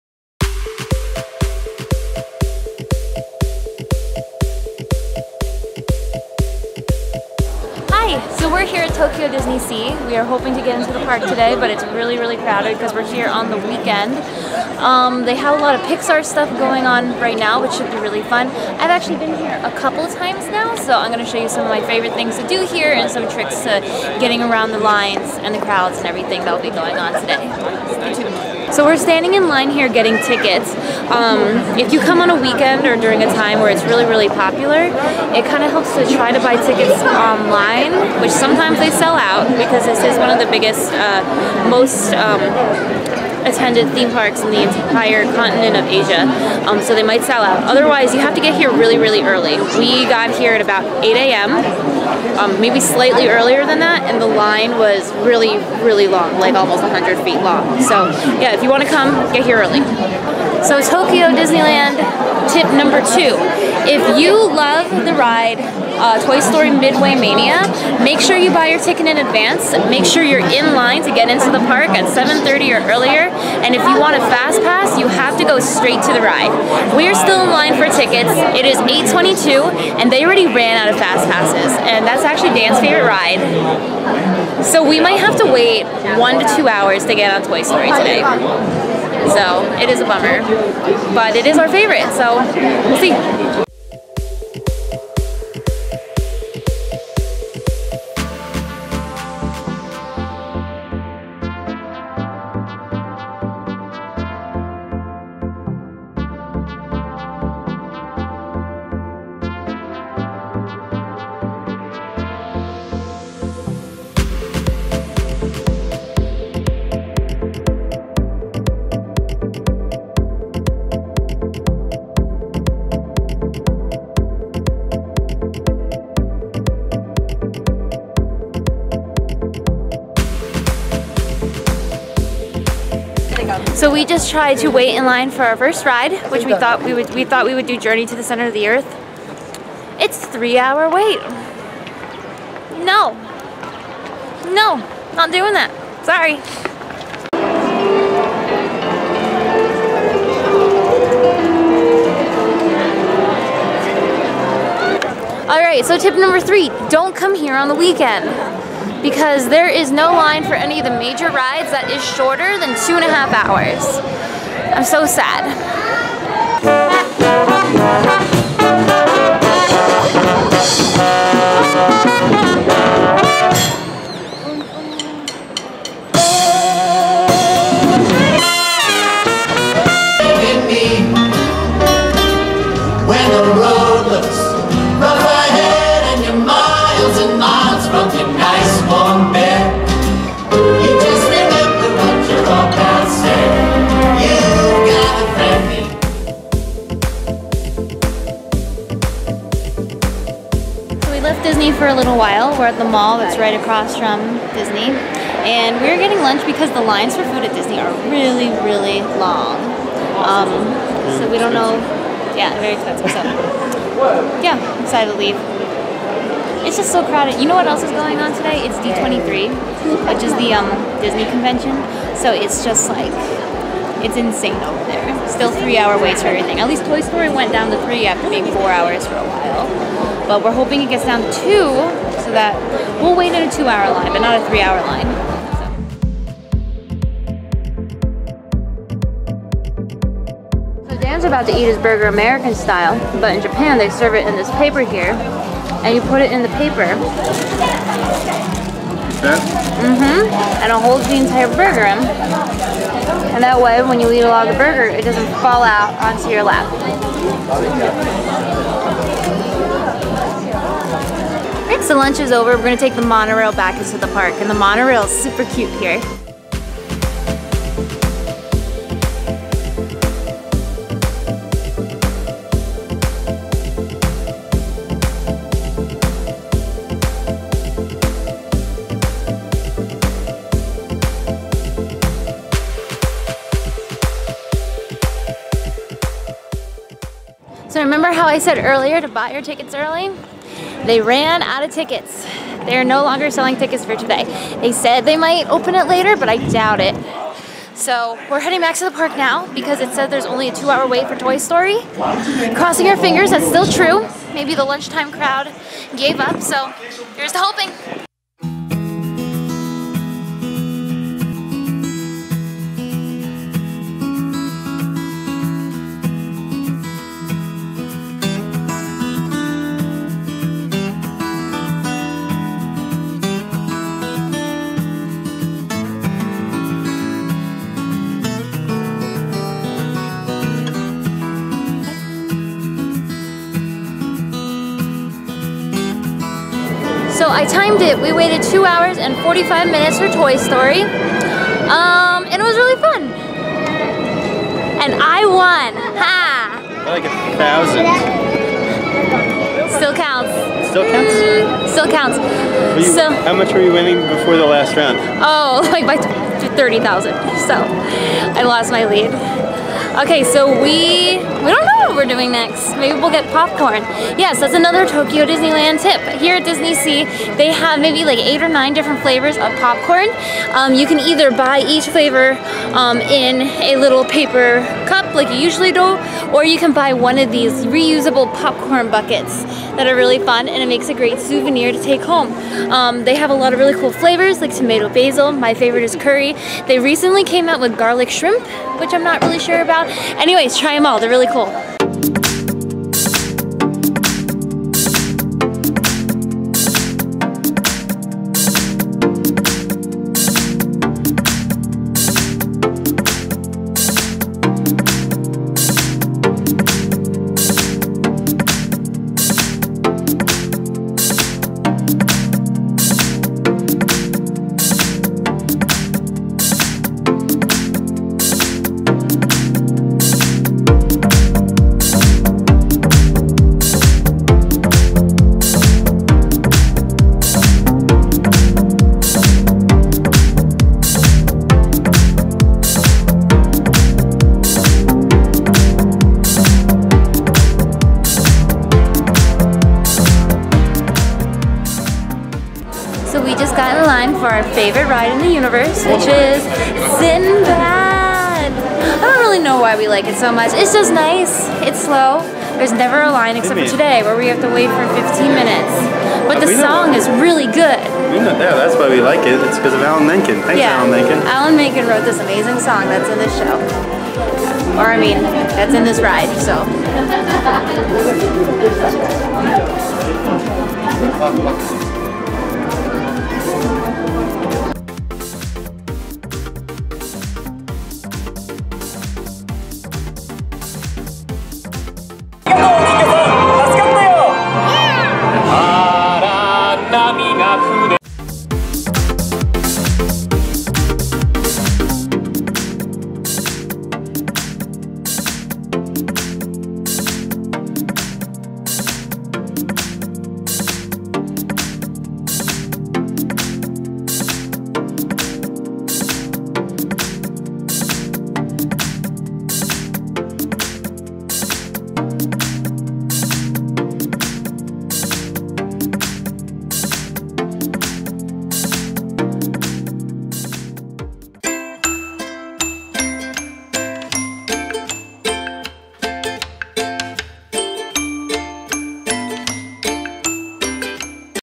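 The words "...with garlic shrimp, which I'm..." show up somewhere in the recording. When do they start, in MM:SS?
06:27.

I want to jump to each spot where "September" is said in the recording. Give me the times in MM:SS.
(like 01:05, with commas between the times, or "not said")
not said.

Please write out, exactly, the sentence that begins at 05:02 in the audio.
Crossing our fingers, that's still true.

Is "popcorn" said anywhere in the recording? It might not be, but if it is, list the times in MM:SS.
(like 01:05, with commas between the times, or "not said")
06:03, 06:09, 06:18.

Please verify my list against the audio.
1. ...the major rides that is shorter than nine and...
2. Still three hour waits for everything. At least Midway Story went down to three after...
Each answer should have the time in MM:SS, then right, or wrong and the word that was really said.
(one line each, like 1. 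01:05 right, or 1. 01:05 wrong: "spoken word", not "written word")
1. 02:40 wrong: "two", not "nine"
2. 03:45 wrong: "Toy", not "Midway".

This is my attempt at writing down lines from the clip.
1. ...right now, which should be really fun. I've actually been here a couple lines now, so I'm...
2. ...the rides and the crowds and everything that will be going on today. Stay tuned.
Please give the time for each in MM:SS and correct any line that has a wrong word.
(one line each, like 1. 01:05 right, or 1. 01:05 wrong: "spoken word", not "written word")
1. 00:17 wrong: "times", not "lines"
2. 00:24 wrong: "lines", not "rides".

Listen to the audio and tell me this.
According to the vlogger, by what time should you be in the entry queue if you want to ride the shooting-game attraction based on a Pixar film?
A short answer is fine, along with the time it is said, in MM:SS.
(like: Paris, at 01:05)
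7:30, at 01:12.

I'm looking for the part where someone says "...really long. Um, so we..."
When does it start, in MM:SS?
03:28.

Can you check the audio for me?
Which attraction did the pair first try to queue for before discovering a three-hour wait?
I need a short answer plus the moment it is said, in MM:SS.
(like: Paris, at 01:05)
Journey to the Center of the Earth, at 02:17.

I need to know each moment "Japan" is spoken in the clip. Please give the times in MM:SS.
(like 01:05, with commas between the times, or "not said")
04:03.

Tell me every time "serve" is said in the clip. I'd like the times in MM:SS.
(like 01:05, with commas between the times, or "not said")
04:03.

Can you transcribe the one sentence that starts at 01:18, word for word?
It is 8.22 and they already ran out of fast passes.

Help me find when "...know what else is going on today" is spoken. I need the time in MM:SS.
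03:37.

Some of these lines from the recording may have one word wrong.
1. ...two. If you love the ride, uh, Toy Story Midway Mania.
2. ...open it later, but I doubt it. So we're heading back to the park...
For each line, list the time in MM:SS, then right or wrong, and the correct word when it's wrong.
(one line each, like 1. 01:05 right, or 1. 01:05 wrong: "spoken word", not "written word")
1. 01:03 right
2. 04:55 right.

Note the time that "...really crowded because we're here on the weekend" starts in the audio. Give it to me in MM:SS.
00:12.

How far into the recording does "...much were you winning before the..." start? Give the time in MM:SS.
05:53.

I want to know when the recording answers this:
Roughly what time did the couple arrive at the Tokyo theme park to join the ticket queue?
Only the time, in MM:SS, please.
00:51.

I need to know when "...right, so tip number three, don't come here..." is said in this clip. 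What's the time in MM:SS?
02:35.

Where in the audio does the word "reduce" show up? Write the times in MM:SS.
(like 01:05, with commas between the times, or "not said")
not said.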